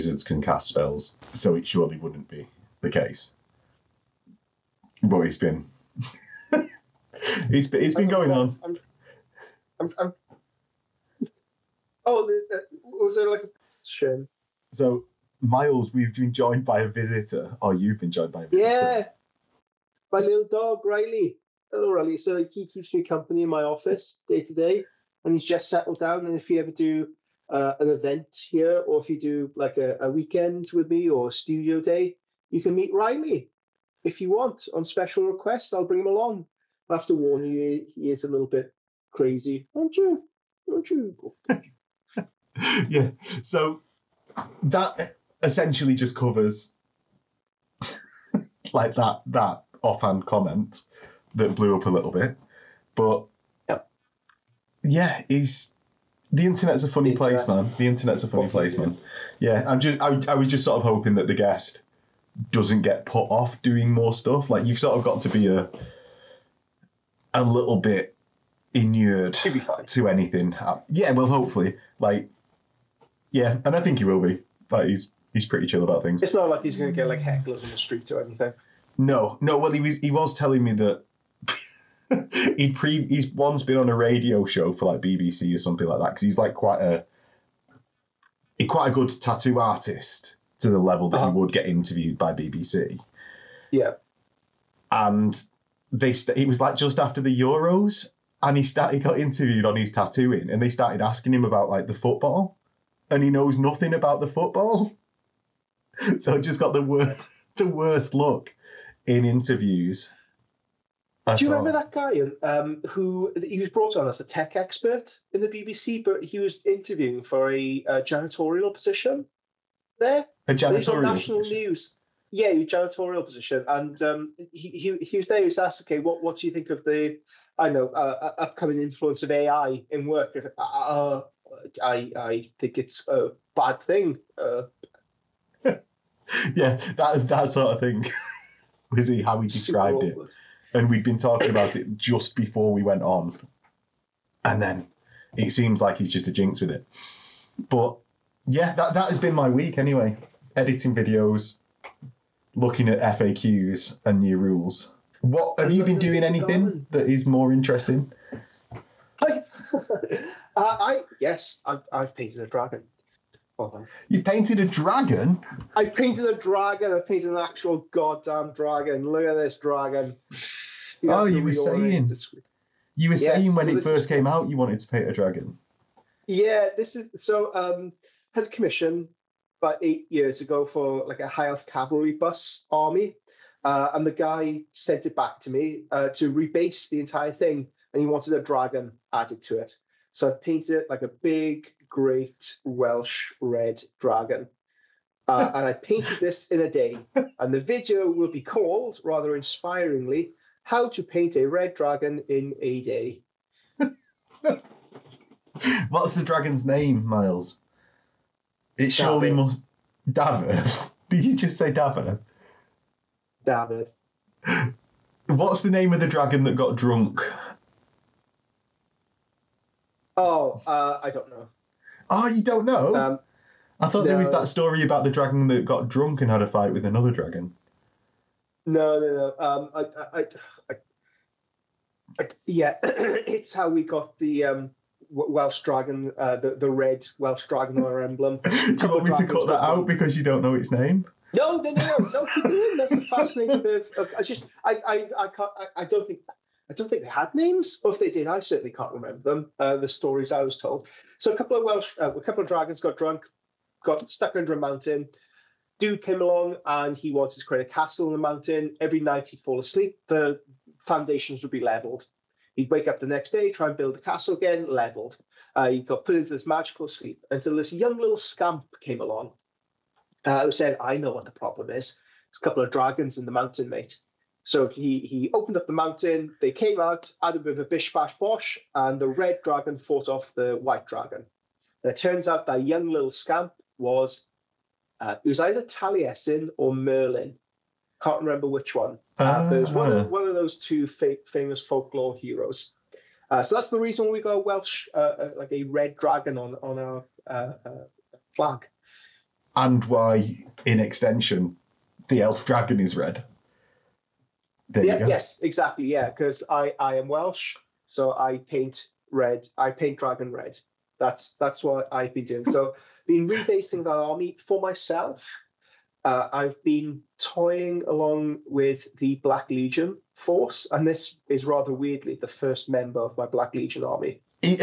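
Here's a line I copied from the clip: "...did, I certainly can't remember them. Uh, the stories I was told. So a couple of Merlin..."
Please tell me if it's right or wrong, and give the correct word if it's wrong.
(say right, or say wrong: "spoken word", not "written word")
wrong: "Welsh", not "Merlin".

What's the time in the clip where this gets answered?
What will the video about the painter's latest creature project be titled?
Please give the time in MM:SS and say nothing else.
03:20.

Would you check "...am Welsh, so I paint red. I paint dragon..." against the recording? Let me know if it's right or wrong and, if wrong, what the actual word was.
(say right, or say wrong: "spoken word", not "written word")
right.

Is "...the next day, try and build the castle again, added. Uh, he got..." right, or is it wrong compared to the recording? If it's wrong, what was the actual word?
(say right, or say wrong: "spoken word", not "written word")
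wrong: "leveled", not "added".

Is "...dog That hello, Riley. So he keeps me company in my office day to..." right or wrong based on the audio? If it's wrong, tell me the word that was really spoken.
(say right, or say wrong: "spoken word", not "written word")
wrong: "Riley", not "That".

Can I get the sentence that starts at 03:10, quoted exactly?
So I painted like a big Great Welsh Red Dragon.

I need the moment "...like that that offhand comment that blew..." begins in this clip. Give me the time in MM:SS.
00:48.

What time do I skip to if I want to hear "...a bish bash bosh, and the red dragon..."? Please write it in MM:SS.
04:37.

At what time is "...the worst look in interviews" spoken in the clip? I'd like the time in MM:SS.
01:47.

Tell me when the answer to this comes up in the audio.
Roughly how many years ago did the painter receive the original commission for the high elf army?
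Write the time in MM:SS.
02:59.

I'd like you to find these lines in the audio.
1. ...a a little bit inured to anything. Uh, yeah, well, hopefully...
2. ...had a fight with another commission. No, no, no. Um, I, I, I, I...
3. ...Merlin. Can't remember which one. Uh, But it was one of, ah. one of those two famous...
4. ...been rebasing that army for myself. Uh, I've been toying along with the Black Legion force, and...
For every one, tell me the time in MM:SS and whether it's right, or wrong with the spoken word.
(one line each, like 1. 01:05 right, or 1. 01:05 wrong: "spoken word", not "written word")
1. 01:05 right
2. 03:46 wrong: "dragon", not "commission"
3. 04:46 right
4. 05:13 right.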